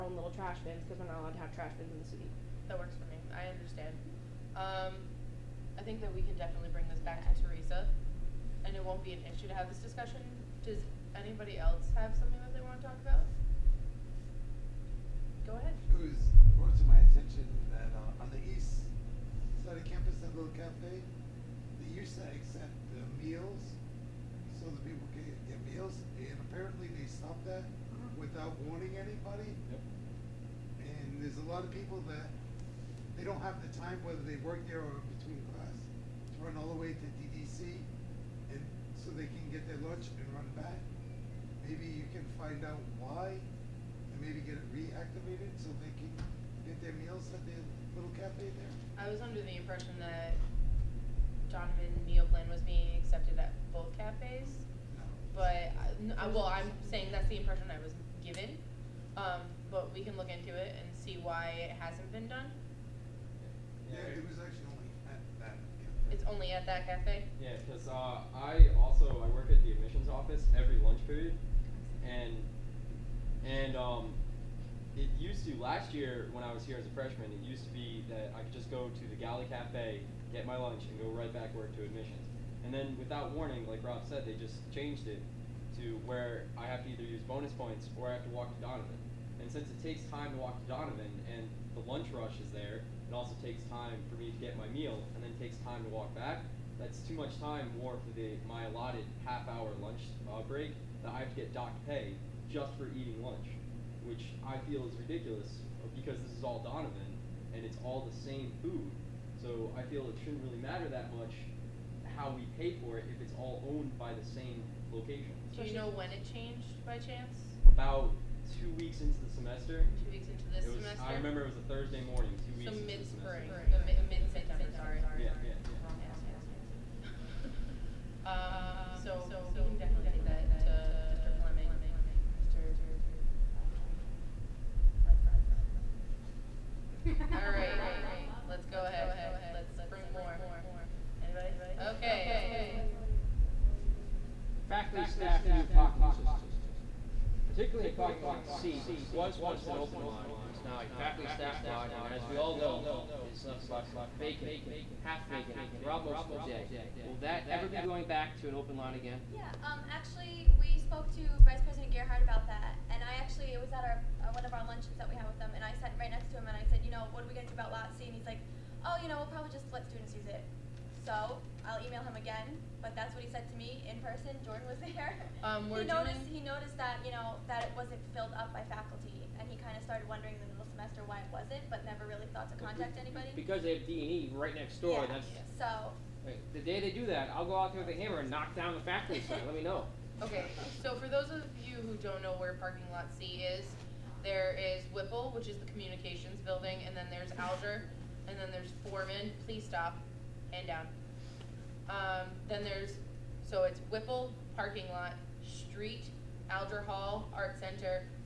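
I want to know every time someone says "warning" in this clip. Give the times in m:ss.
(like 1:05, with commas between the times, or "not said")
0:28, 1:23.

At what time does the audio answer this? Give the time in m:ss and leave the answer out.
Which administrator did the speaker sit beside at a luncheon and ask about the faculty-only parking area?
2:41.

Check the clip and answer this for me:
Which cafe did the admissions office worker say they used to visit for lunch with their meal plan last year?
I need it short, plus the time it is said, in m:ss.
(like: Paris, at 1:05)
Galley Cafe, at 1:19.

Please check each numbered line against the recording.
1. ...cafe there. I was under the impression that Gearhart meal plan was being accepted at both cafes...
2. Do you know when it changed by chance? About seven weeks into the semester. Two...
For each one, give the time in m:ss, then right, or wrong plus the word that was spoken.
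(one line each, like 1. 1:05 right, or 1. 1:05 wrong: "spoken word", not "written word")
1. 0:48 wrong: "Donovan", not "Gearhart"
2. 1:55 wrong: "two", not "seven".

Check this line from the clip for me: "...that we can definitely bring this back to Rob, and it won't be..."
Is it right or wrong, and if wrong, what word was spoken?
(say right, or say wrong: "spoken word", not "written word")
wrong: "Teresa", not "Rob".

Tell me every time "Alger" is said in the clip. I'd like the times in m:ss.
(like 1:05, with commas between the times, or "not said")
3:17, 3:26.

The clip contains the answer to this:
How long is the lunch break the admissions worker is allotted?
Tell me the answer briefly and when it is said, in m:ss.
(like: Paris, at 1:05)
half hour, at 1:39.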